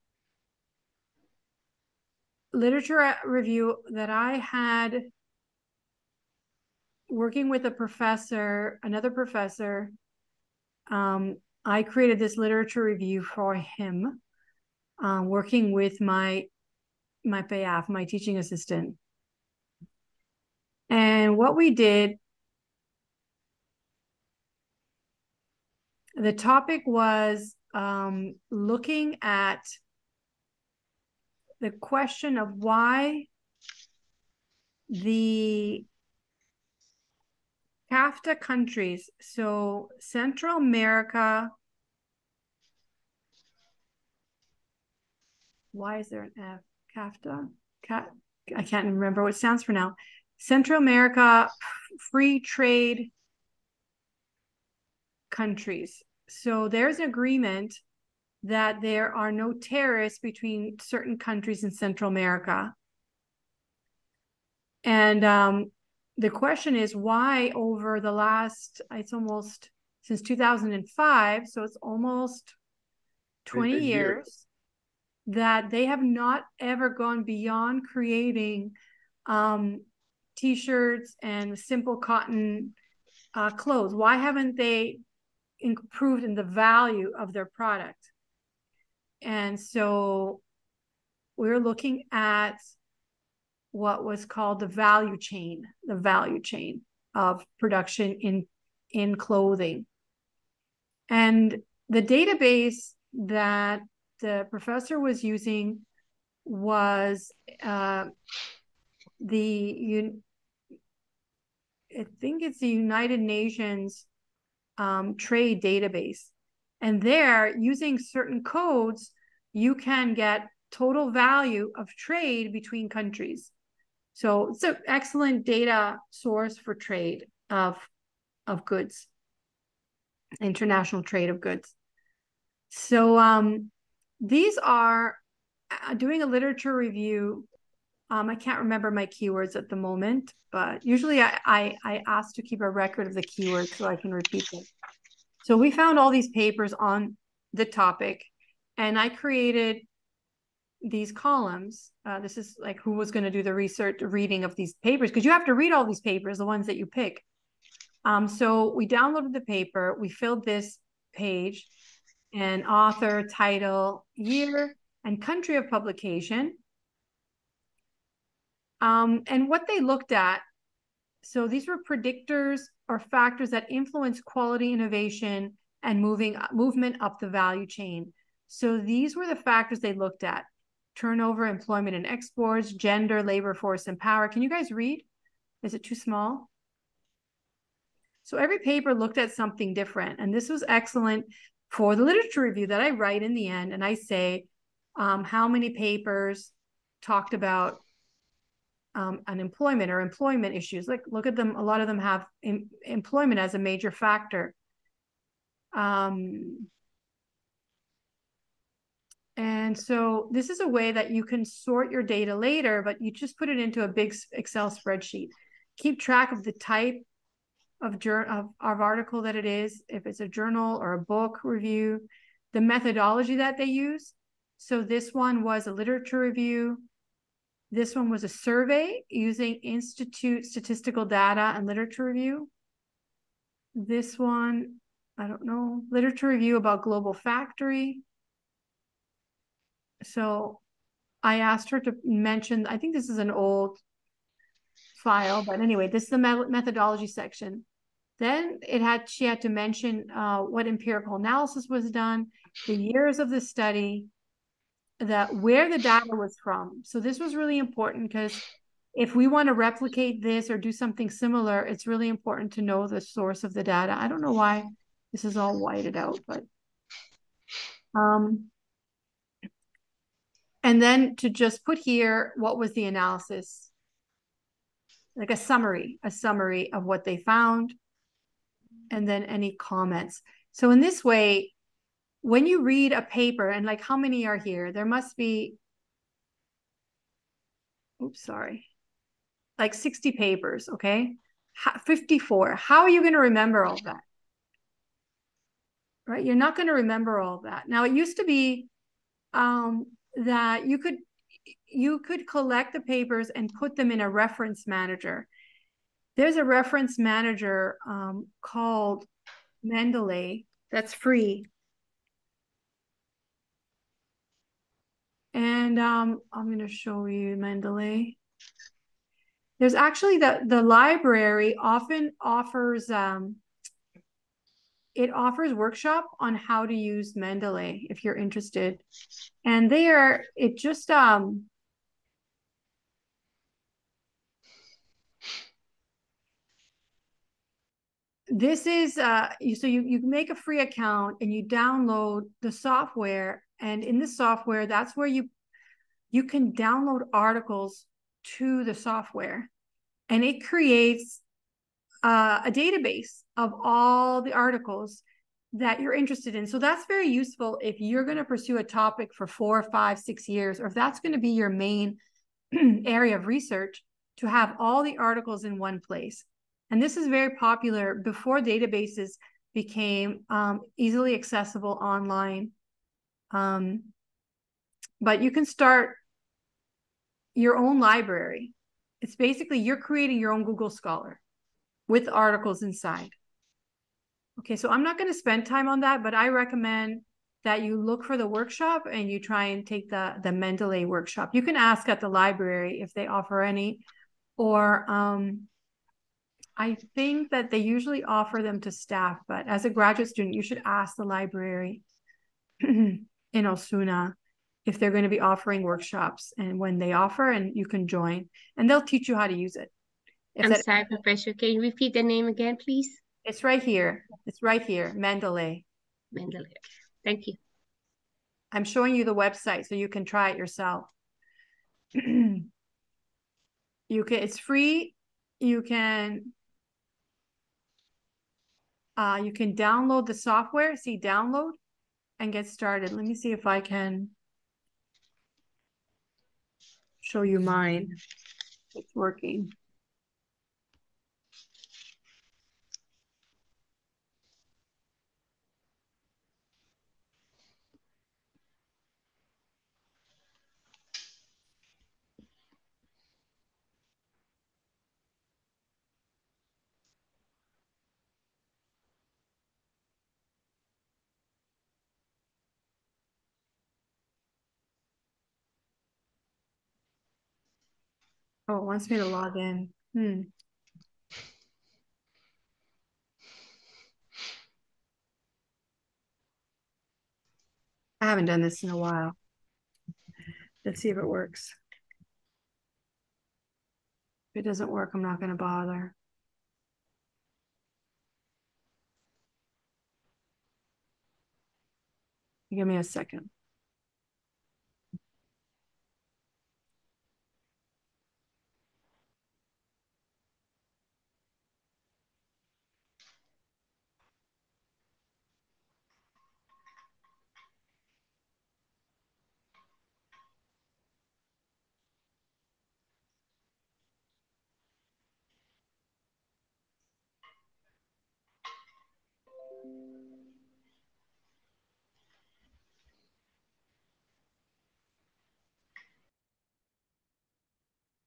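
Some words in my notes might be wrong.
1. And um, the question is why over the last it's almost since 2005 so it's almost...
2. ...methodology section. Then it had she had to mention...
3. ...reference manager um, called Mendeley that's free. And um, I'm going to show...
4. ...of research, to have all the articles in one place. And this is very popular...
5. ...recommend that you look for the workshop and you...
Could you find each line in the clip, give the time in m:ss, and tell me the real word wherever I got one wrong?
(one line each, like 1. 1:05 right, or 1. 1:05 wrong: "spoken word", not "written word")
1. 1:04 right
2. 4:06 right
3. 5:06 right
4. 6:03 right
5. 6:26 right.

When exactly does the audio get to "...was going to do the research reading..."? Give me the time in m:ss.
2:32.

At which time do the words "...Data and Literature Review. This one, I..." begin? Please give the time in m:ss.
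3:51.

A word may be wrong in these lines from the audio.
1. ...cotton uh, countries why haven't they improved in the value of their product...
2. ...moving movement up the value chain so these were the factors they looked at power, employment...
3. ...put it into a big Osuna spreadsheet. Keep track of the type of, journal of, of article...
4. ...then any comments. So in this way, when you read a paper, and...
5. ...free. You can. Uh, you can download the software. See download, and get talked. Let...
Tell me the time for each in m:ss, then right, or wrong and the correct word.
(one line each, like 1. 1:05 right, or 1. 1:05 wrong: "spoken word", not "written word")
1. 1:21 wrong: "clothes", not "countries"
2. 2:56 wrong: "turnover", not "power"
3. 3:33 wrong: "Excel", not "Osuna"
4. 4:39 right
5. 7:04 wrong: "started", not "talked".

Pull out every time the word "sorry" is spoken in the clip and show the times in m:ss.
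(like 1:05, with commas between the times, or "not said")
4:48, 6:50.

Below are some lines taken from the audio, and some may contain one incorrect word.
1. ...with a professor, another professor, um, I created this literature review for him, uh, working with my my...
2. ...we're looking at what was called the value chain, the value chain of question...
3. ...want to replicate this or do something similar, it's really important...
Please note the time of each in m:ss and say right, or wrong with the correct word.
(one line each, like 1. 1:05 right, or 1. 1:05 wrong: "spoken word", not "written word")
1. 0:07 right
2. 1:31 wrong: "production", not "question"
3. 4:19 right.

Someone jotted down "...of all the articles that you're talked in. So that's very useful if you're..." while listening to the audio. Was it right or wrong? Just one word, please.
wrong.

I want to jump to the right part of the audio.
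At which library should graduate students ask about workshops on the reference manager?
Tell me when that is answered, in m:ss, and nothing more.
6:43.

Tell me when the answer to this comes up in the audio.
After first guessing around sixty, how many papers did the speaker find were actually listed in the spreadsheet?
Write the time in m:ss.
4:51.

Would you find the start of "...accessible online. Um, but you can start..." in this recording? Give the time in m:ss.
6:11.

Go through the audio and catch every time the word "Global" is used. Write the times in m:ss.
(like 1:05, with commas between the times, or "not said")
3:56.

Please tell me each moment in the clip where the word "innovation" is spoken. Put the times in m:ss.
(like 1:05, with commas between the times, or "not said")
2:54.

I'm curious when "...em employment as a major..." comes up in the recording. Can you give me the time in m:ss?
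3:22.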